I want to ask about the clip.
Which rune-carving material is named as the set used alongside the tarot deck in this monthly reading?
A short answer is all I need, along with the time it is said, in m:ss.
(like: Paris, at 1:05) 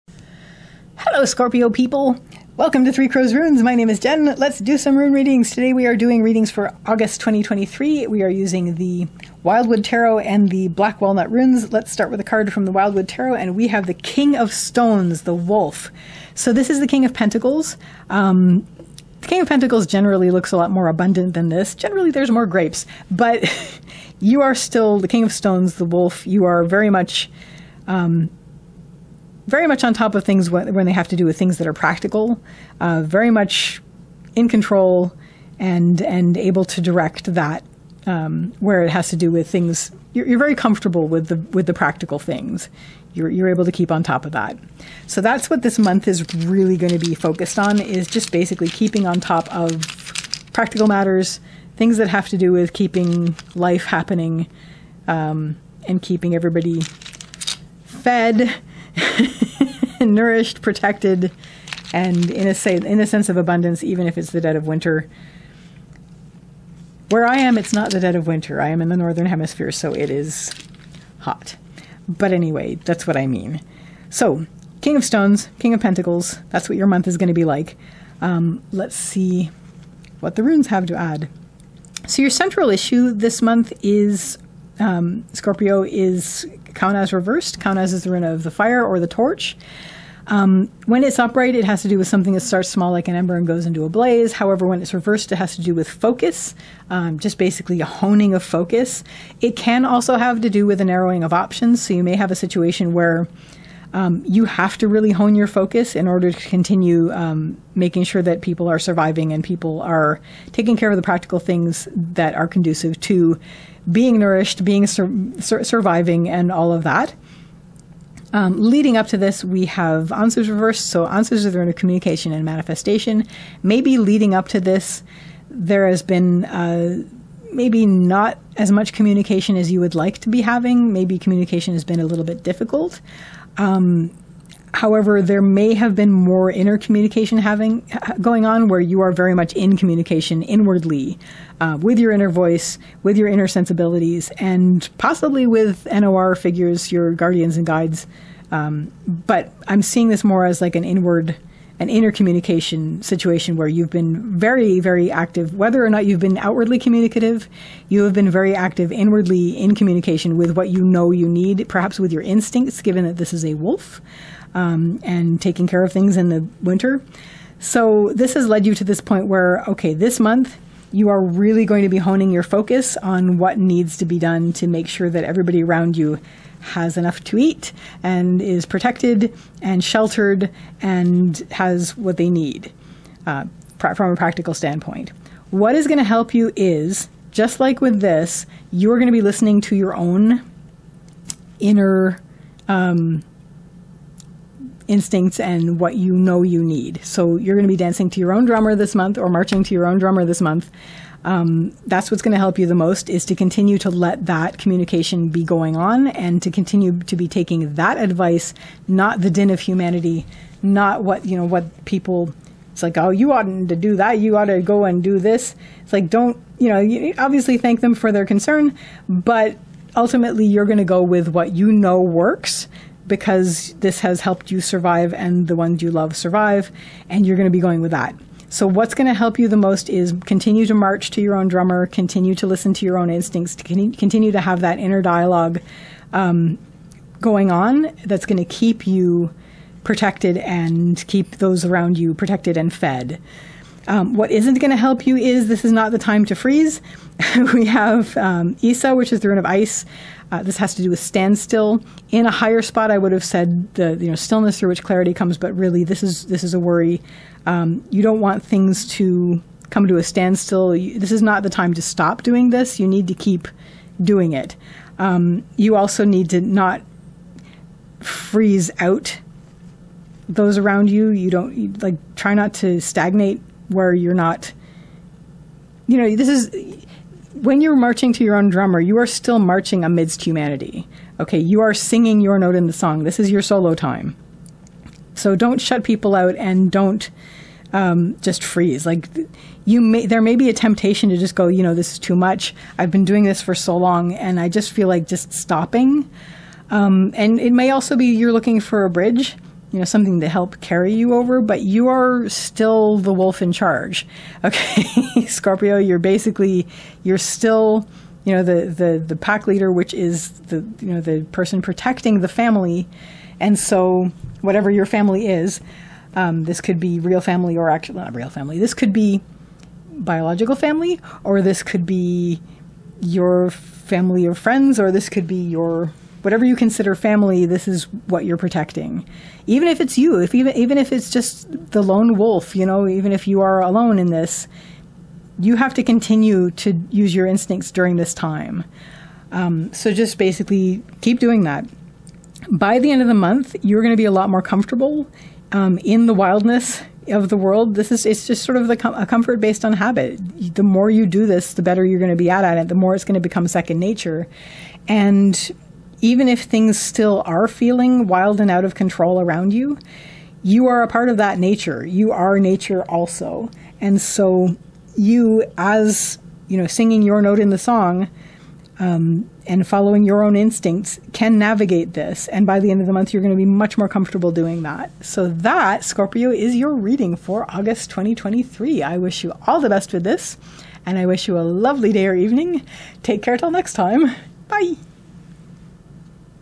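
Black Walnut, at 0:10.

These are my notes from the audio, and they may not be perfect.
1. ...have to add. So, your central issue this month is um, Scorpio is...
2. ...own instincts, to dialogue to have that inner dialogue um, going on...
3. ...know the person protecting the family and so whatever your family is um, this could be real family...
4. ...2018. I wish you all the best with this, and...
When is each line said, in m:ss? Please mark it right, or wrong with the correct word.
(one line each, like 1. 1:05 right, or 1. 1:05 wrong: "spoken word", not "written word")
1. 1:20 right
2. 3:52 wrong: "continue", not "dialogue"
3. 5:10 right
4. 6:17 wrong: "2023", not "2018".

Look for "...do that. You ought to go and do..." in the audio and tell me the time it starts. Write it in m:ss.
3:33.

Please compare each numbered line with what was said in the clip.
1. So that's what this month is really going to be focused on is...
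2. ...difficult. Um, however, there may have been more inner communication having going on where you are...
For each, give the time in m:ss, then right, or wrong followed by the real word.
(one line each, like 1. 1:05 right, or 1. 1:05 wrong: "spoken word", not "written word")
1. 0:45 right
2. 2:12 right.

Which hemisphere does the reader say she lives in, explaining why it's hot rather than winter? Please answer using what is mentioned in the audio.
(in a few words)
Northern hemisphere.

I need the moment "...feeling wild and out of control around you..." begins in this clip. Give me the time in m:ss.
5:57.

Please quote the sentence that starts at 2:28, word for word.
Um, but I'm seeing this more as like an inward an intercommunication situation where you've been very, very active.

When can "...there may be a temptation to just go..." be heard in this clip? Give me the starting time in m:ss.
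4:50.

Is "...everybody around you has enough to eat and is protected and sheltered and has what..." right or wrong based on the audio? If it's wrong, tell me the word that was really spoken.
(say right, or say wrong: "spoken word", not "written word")
right.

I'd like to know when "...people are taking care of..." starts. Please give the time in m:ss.
1:49.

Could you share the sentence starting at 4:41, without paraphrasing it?
Okay, you are singing your note in the song.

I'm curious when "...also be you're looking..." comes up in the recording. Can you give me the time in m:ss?
4:57.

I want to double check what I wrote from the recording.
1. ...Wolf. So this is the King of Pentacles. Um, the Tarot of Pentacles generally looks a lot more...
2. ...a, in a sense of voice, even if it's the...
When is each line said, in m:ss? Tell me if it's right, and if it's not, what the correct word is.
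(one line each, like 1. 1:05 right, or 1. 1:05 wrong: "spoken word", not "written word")
1. 0:15 wrong: "King", not "Tarot"
2. 1:02 wrong: "abundance", not "voice".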